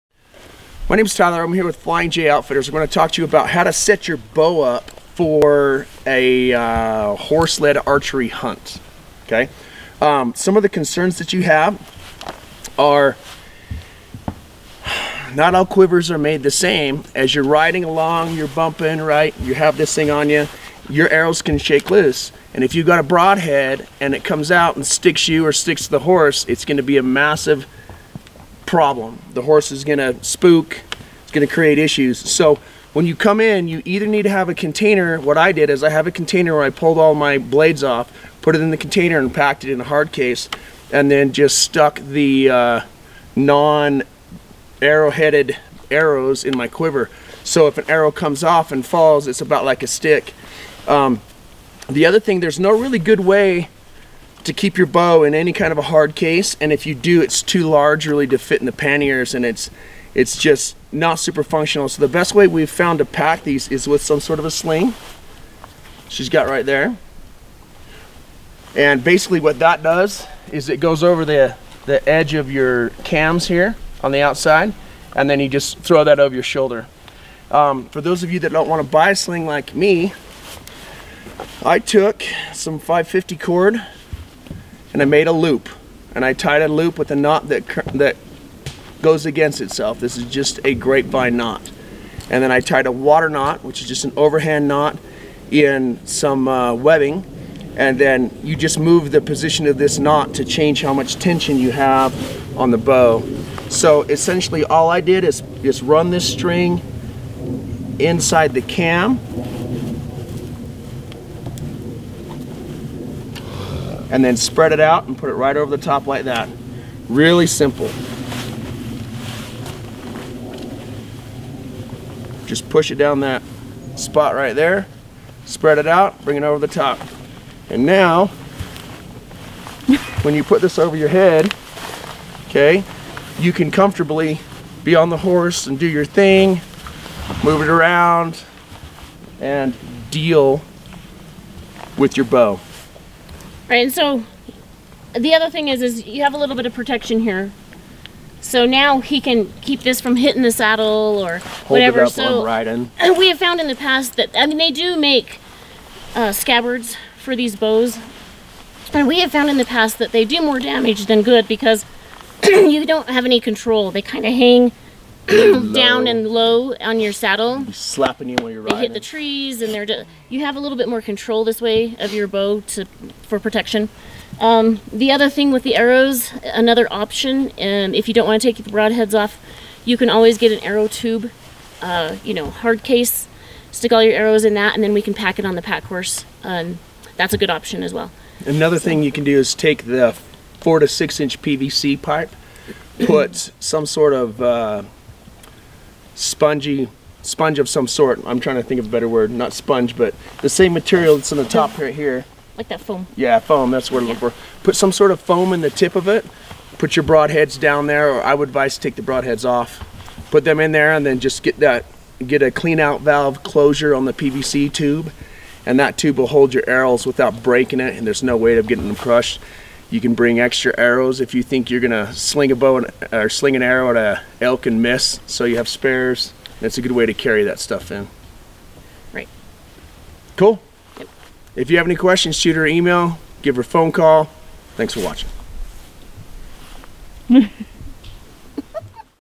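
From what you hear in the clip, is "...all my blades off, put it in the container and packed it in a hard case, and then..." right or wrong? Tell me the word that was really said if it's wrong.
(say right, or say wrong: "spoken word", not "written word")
right.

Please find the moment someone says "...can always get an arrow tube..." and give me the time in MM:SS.
02:59.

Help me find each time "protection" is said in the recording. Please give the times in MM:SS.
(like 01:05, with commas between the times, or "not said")
02:26, 02:53.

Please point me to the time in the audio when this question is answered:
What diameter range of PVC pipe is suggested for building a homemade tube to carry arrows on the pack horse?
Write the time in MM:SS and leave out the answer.
03:10.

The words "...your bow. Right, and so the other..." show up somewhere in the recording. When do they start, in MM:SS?
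02:22.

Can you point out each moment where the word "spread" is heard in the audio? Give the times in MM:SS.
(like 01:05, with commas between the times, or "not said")
01:54, 02:05.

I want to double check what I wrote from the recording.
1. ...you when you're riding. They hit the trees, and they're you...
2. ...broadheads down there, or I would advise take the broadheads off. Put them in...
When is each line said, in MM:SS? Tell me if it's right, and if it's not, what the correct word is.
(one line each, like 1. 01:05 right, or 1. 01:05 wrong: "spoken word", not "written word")
1. 02:48 right
2. 03:27 right.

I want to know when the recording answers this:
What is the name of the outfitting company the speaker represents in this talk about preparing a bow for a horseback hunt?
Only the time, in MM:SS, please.
00:01.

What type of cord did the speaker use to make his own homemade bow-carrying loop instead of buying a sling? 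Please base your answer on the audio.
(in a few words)
550 cord.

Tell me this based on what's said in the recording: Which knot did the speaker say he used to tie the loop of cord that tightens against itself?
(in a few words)
grapevine knot.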